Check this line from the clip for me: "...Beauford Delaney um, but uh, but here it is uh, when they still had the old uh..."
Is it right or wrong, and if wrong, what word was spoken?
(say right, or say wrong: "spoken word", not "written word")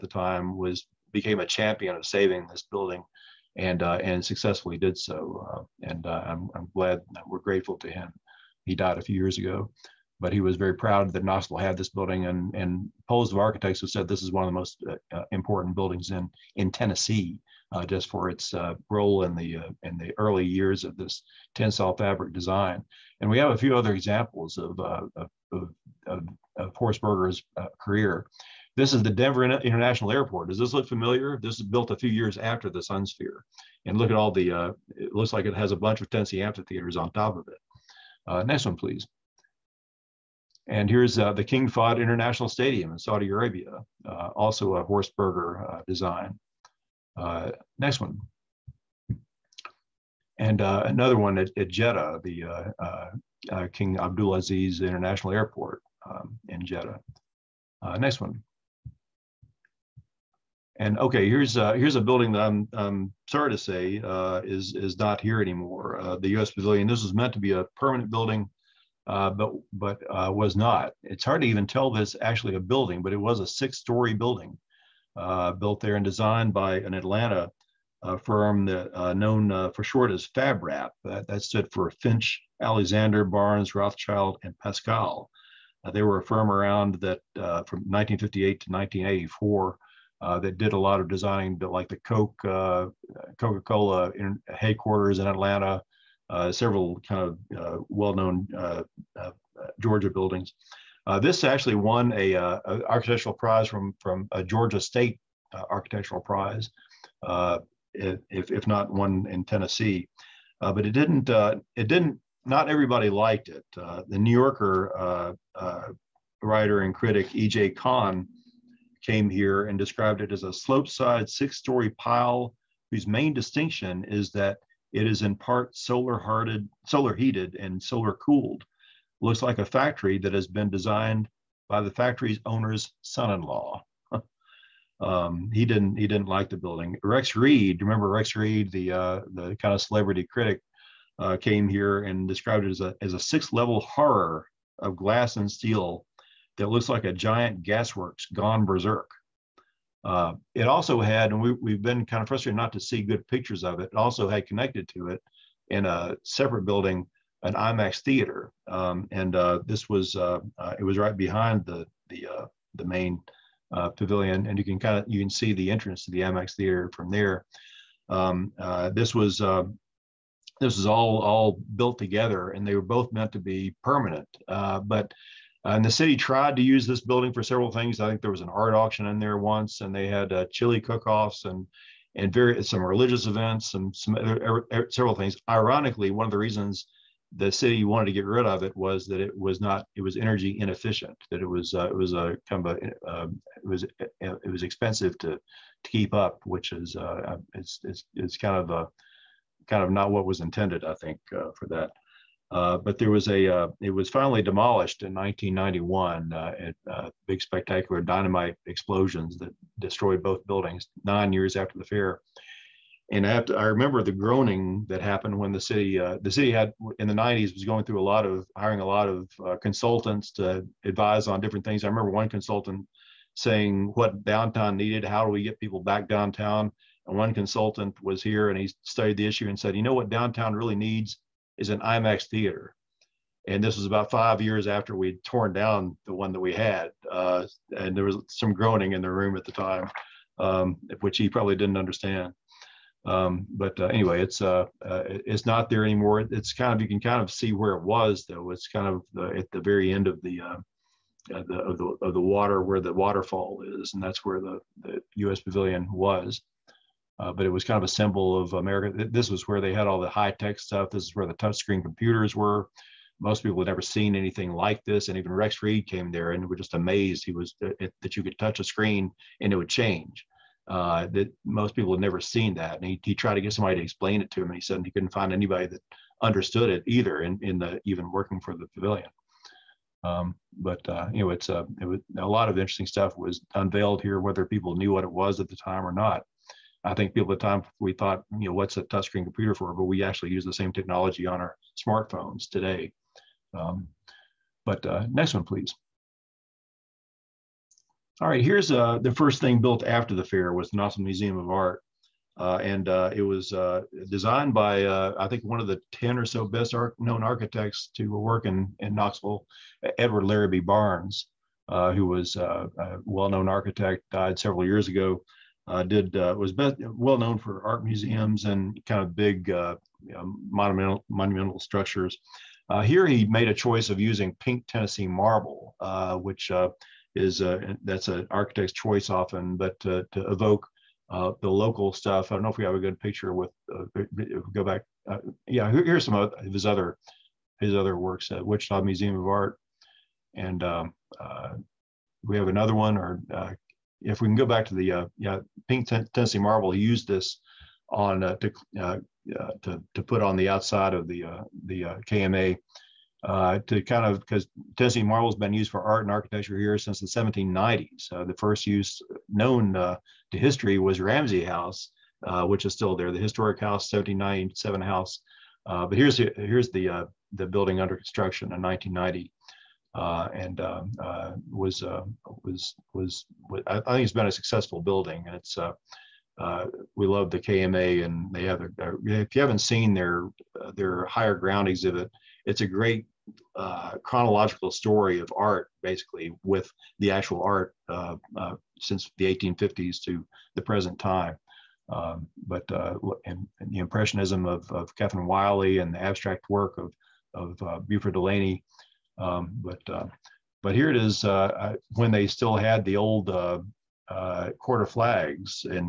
right.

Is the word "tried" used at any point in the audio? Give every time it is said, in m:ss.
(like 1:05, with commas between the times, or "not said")
2:56, 4:33.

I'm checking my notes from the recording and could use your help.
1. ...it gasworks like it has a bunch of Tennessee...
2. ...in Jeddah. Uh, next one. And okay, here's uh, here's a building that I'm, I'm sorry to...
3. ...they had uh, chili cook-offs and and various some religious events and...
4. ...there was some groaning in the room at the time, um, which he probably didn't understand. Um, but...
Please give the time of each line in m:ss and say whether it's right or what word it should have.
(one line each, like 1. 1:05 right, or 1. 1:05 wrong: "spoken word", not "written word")
1. 0:34 wrong: "looks", not "gasworks"
2. 0:56 right
3. 2:59 right
4. 3:57 right.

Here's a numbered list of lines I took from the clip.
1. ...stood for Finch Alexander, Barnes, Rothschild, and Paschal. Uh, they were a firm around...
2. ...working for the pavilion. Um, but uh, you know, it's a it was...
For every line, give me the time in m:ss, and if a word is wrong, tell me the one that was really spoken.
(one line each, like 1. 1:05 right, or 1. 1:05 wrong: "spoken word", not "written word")
1. 1:21 right
2. 4:38 right.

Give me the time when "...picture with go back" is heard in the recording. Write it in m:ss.
5:32.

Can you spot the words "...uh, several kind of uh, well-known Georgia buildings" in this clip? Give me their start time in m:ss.
1:36.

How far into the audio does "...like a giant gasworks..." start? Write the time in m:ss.
2:26.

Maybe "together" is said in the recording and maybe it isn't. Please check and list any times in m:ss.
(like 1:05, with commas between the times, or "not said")
2:51.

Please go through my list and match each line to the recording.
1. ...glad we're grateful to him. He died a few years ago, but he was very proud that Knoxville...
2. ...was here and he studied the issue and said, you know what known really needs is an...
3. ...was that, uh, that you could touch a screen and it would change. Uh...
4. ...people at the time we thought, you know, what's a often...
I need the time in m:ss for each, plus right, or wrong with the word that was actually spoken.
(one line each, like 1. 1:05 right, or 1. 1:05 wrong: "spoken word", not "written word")
1. 0:06 right
2. 3:48 wrong: "downtown", not "known"
3. 4:27 right
4. 4:47 wrong: "touchscreen", not "often".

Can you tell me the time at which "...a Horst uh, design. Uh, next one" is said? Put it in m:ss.
0:44.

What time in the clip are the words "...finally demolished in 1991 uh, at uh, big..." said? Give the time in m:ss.
3:24.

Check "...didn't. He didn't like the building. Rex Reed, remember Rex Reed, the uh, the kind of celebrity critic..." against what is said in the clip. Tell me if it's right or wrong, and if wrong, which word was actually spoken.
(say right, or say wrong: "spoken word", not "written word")
right.